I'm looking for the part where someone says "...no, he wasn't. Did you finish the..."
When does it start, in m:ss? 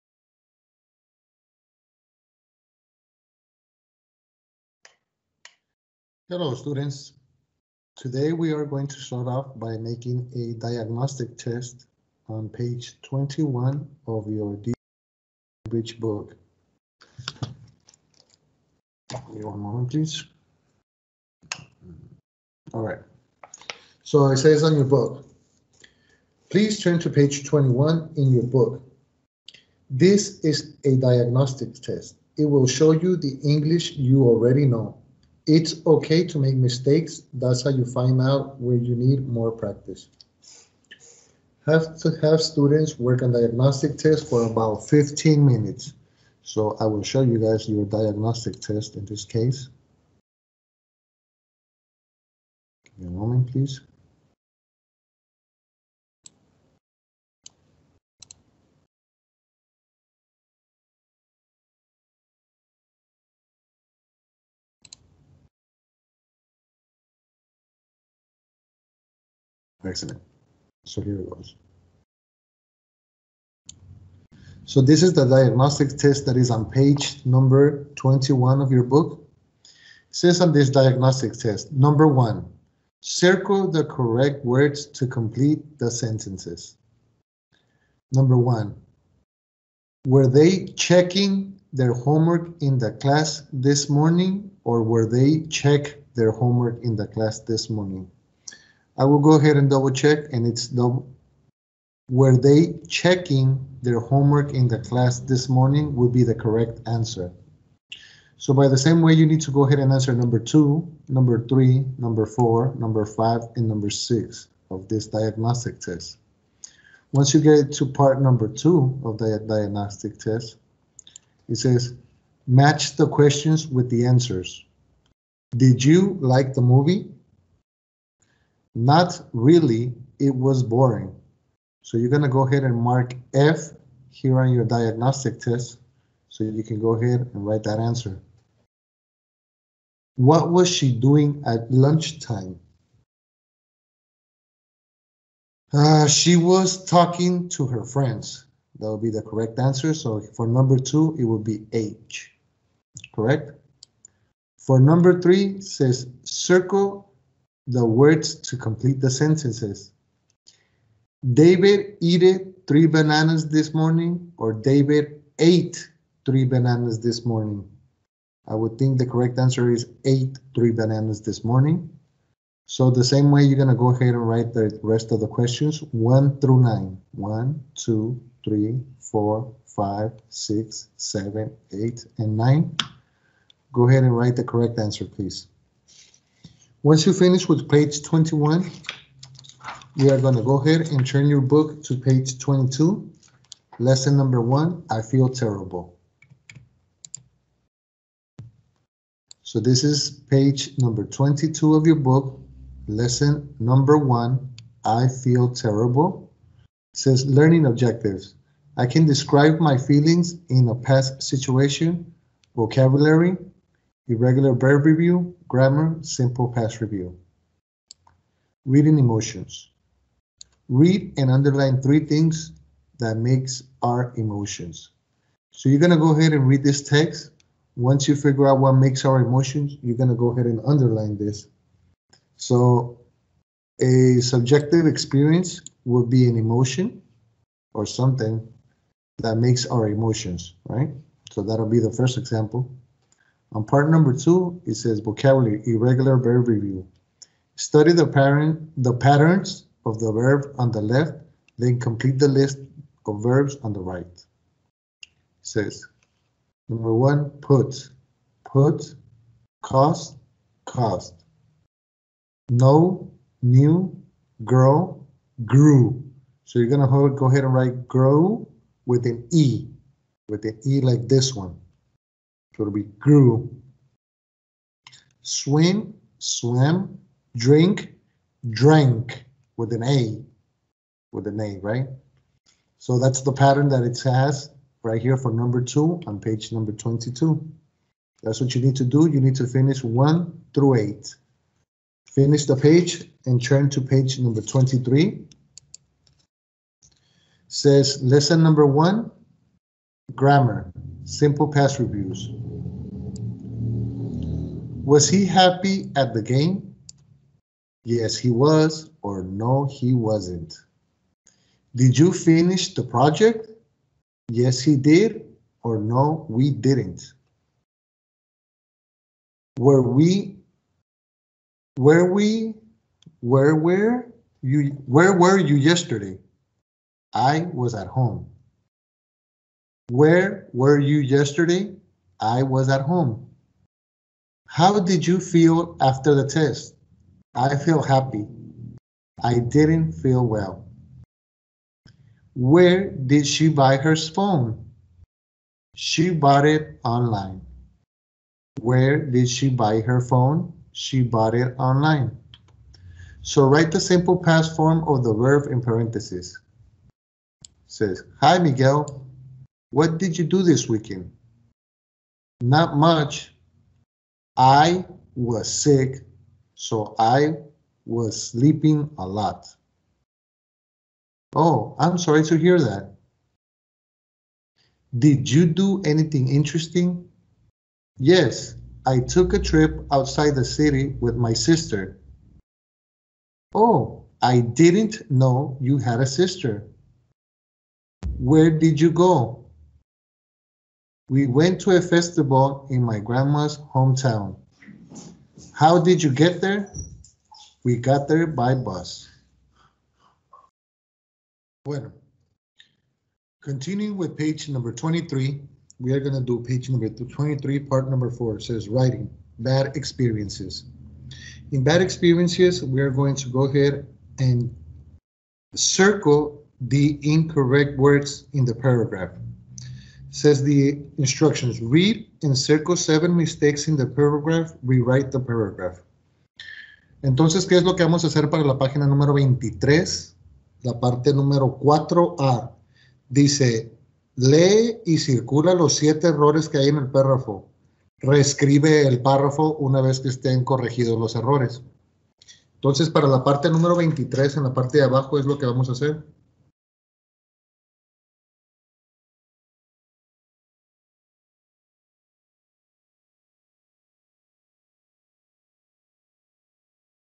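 5:09.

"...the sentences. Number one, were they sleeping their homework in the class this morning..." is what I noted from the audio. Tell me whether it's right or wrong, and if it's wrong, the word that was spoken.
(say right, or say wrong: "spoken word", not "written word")
wrong: "checking", not "sleeping".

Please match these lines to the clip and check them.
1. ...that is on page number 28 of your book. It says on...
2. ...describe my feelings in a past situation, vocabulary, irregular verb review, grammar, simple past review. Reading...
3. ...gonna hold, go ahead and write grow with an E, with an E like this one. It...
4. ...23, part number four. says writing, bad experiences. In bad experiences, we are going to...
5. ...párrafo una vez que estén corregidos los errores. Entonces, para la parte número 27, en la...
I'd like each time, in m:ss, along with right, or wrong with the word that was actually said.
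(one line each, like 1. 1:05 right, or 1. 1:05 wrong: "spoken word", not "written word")
1. 1:16 wrong: "21", not "28"
2. 3:29 right
3. 4:26 right
4. 6:46 right
5. 7:19 wrong: "23", not "27".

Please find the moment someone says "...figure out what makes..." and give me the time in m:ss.
3:48.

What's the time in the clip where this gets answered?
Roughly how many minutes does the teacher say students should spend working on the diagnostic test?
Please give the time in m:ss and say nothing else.
0:44.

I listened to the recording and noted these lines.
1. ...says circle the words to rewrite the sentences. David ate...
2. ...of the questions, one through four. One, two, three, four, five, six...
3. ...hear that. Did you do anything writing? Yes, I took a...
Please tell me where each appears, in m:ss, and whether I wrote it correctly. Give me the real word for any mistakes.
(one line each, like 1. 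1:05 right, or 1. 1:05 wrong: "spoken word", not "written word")
1. 2:35 wrong: "complete", not "rewrite"
2. 2:55 wrong: "nine", not "four"
3. 6:12 wrong: "interesting", not "writing".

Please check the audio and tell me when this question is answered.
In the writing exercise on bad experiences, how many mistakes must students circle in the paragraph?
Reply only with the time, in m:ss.
7:02.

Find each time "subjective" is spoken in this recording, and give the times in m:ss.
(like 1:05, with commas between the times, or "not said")
3:54.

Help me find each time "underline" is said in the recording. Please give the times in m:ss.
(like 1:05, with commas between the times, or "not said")
3:41, 3:50.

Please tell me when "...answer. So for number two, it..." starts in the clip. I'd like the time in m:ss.
2:29.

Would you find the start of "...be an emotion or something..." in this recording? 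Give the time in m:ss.
3:56.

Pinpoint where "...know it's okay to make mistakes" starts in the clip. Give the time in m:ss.
0:34.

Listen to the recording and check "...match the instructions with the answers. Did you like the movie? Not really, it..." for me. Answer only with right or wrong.
wrong.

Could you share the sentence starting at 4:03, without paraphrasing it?
On part number two, it says vocabulary, irregular verb review.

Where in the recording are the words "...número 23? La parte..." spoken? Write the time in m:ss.
7:08.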